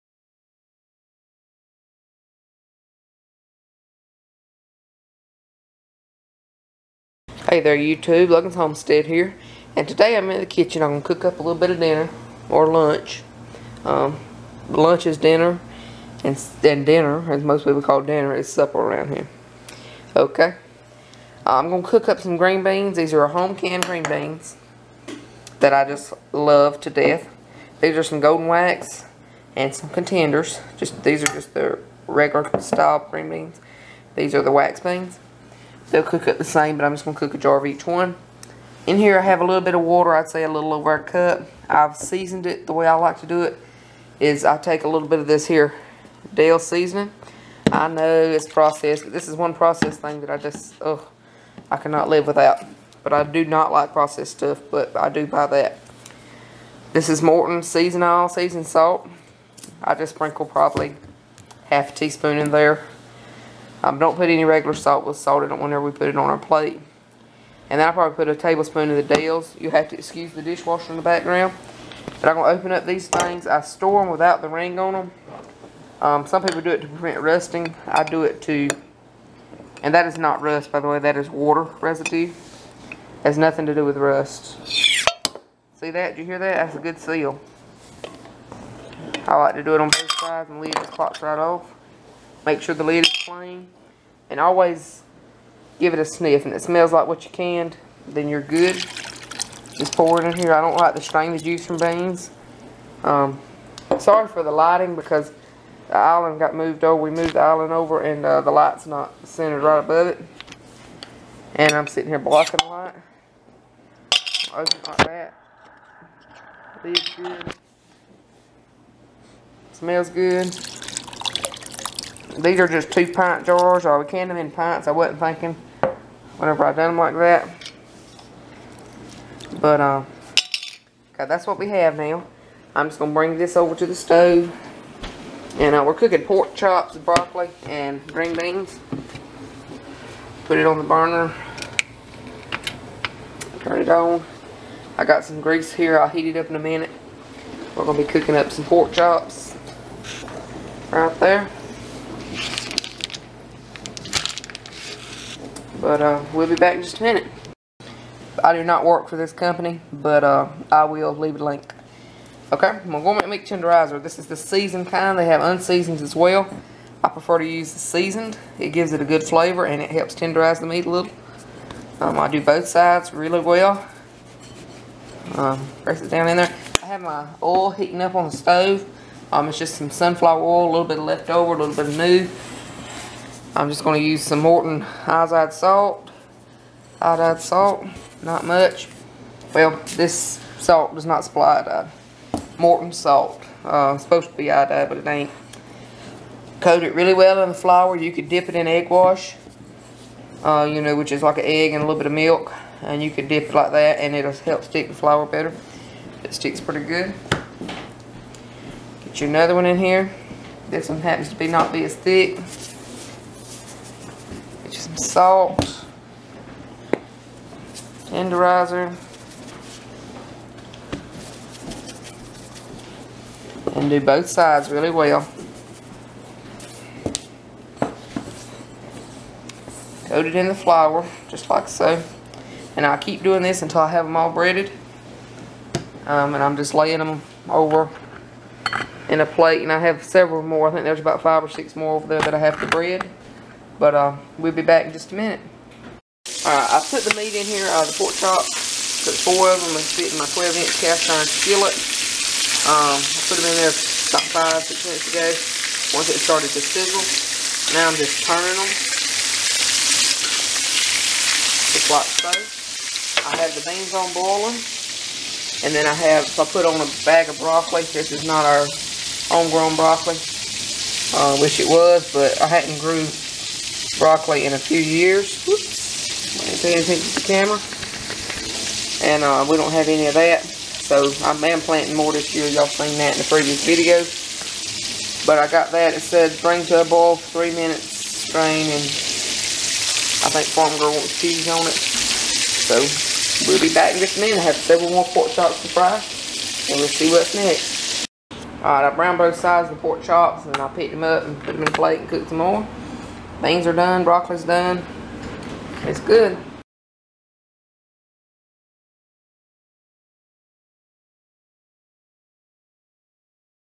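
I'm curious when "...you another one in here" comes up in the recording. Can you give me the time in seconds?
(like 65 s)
209 s.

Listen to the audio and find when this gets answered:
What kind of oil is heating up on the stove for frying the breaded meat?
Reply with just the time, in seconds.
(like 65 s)
179 s.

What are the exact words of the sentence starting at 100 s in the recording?
I don't like to strain the juice from beans.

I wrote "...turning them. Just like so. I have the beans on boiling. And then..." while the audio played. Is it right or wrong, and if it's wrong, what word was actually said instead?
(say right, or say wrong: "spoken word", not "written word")
right.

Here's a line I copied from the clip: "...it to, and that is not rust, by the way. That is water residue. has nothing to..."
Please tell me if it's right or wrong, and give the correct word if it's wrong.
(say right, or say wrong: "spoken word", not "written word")
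right.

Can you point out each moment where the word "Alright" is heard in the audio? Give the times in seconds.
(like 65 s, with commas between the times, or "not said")
246 s, 298 s.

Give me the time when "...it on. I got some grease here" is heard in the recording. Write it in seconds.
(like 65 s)
143 s.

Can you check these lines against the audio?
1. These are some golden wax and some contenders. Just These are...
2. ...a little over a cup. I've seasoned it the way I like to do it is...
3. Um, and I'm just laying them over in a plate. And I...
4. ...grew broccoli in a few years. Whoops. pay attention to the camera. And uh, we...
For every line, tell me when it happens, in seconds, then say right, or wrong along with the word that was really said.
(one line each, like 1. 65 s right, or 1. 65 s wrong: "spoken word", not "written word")
1. 27 s right
2. 40 s right
3. 236 s right
4. 272 s right.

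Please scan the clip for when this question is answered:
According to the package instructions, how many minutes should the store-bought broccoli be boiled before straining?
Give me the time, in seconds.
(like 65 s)
287 s.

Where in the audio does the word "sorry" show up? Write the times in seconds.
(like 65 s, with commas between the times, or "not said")
103 s.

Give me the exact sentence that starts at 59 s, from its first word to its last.
I just sprinkle probably half a teaspoon in there.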